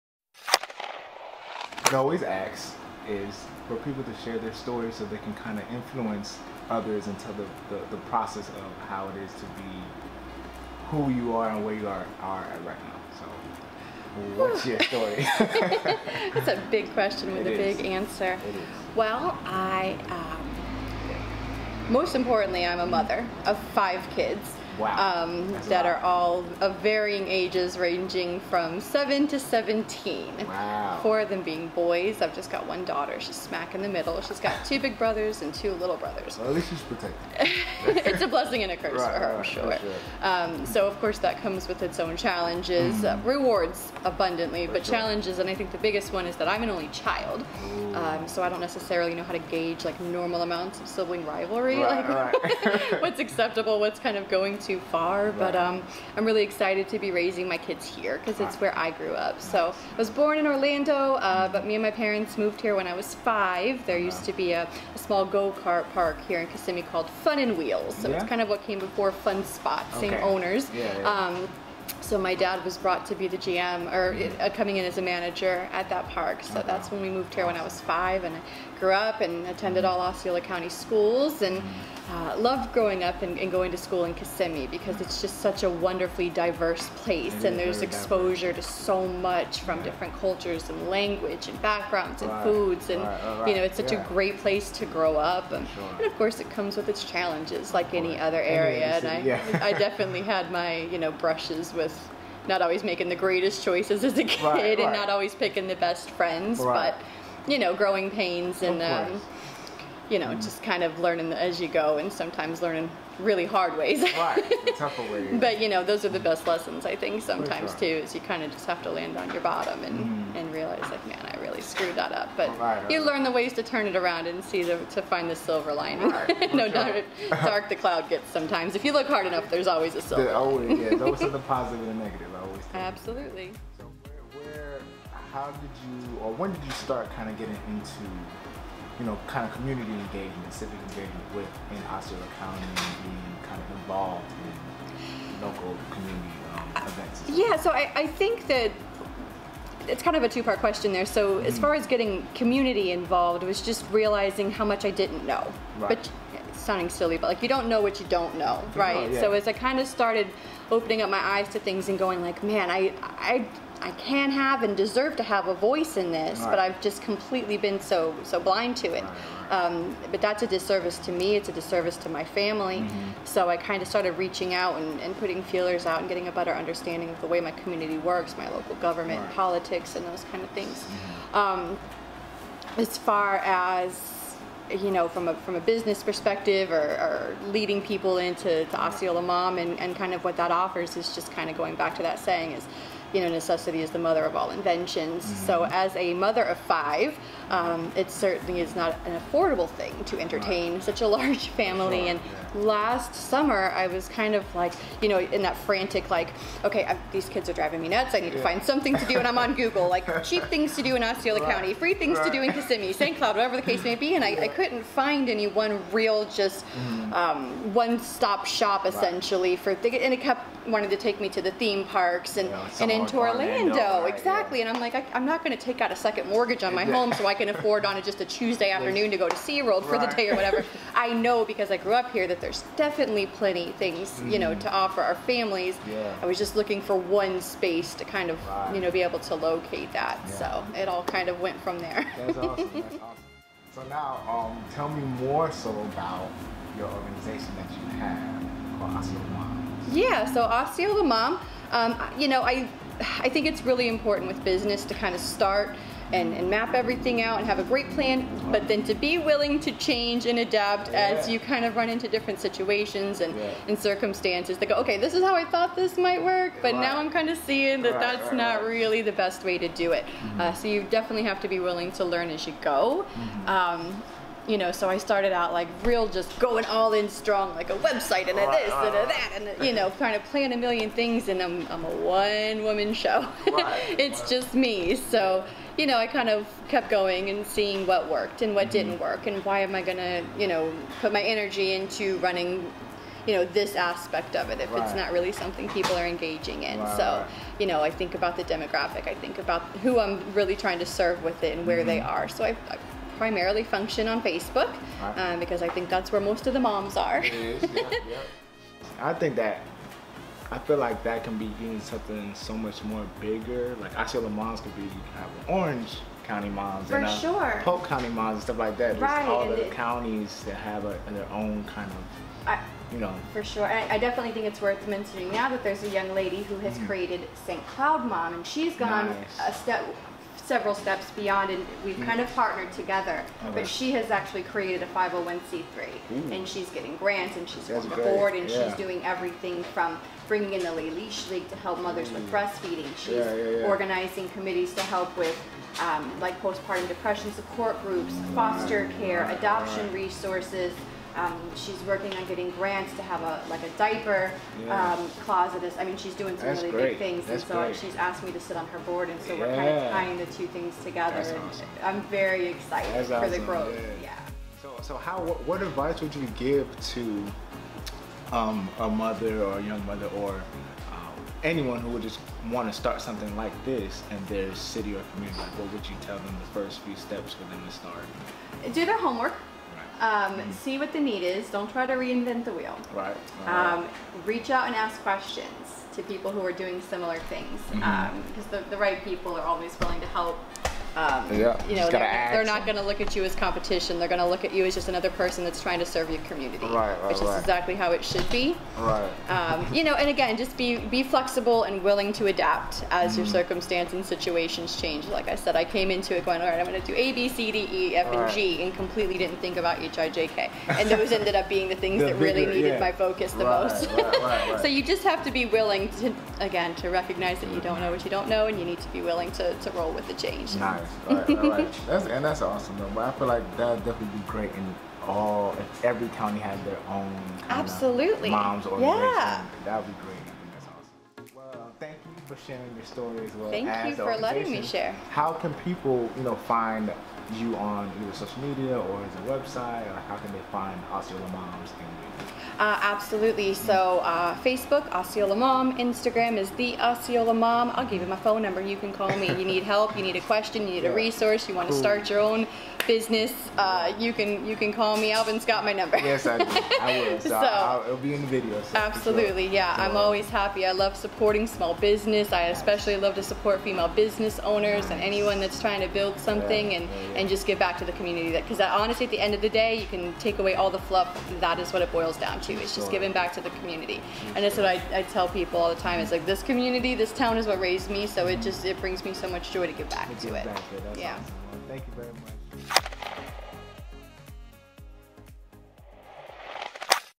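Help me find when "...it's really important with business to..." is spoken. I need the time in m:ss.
4:13.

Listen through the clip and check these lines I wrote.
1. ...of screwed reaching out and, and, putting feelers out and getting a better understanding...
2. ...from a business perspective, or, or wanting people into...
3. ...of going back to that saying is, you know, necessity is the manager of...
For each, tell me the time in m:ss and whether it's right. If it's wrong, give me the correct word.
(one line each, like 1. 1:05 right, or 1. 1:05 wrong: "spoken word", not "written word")
1. 2:53 wrong: "started", not "screwed"
2. 3:05 wrong: "leading", not "wanting"
3. 3:11 wrong: "mother", not "manager".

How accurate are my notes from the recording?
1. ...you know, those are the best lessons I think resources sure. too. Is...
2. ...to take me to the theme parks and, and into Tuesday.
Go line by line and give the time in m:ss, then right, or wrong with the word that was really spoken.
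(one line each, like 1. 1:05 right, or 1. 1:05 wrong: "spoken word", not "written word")
1. 1:55 wrong: "sometimes", not "resources"
2. 3:40 wrong: "Orlando", not "Tuesday".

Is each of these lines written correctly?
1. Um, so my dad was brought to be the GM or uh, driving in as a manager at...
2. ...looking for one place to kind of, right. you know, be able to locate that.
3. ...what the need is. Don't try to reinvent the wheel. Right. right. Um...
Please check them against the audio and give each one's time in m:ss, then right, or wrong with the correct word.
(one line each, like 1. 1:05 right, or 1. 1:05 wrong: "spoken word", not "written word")
1. 1:11 wrong: "coming", not "driving"
2. 3:56 wrong: "space", not "place"
3. 6:20 right.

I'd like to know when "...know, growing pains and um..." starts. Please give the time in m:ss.
1:47.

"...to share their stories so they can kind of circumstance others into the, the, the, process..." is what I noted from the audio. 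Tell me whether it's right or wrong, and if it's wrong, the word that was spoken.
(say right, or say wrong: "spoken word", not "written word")
wrong: "influence", not "circumstance".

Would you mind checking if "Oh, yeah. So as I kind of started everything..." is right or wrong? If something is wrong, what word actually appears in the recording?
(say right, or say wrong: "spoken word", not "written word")
wrong: "opening", not "everything".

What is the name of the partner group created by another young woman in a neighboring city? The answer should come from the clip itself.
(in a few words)
St. Cloud Mom.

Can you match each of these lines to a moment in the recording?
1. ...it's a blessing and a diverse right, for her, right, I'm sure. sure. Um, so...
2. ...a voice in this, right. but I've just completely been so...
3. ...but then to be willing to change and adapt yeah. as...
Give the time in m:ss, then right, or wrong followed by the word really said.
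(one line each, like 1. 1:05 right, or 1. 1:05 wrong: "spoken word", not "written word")
1. 0:38 wrong: "curse", not "diverse"
2. 2:45 right
3. 4:18 right.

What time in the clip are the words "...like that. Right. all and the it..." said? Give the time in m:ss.
5:18.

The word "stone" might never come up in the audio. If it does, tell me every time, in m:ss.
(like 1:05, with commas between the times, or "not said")
not said.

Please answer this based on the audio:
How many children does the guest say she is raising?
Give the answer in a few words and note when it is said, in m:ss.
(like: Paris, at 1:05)
5, at 0:23.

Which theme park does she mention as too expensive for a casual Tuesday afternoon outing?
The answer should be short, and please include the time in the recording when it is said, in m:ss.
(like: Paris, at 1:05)
SeaWorld, at 3:49.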